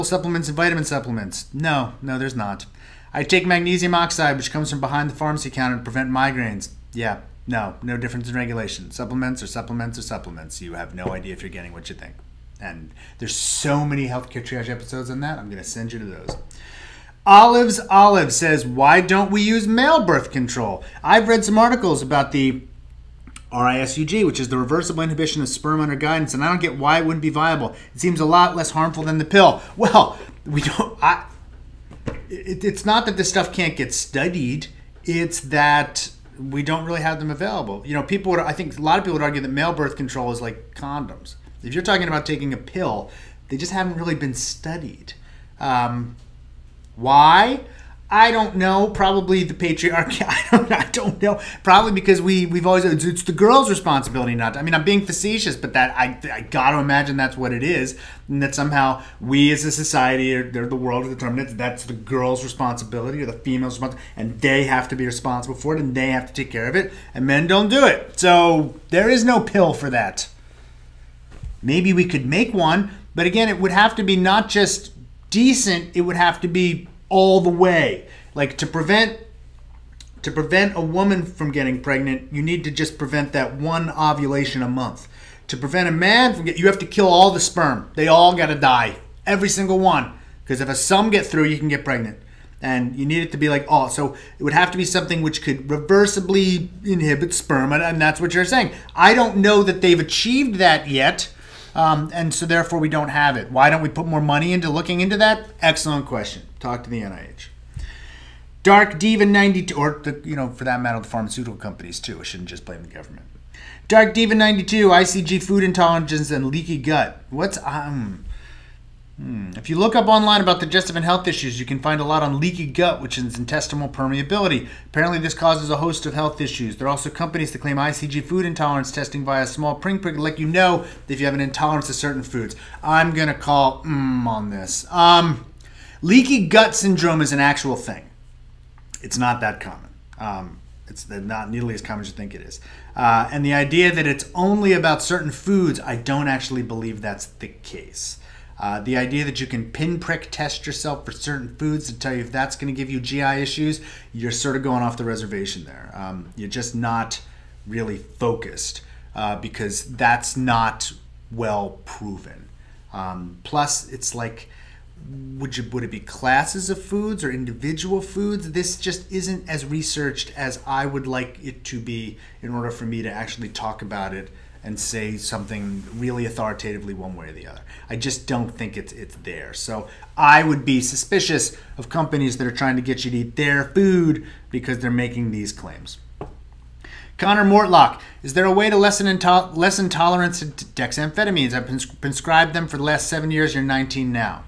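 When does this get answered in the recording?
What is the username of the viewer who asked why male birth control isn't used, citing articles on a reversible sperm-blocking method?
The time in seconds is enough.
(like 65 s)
17 s.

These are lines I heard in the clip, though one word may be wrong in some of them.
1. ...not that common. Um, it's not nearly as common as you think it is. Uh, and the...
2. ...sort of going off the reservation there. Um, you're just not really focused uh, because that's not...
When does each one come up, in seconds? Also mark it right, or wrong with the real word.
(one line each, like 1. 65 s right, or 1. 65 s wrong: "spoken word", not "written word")
1. 139 s right
2. 154 s right.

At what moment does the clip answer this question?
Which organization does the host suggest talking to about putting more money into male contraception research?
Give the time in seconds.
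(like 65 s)
107 s.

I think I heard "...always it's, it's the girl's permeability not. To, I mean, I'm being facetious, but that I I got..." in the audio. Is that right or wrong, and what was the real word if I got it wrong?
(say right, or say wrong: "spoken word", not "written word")
wrong: "responsibility", not "permeability".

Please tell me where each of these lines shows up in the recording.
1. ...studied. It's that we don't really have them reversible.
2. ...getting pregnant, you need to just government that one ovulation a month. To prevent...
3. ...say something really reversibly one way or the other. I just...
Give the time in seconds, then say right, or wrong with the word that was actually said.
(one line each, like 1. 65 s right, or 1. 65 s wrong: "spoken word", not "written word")
1. 33 s wrong: "available", not "reversible"
2. 81 s wrong: "prevent", not "government"
3. 174 s wrong: "authoritatively", not "reversibly".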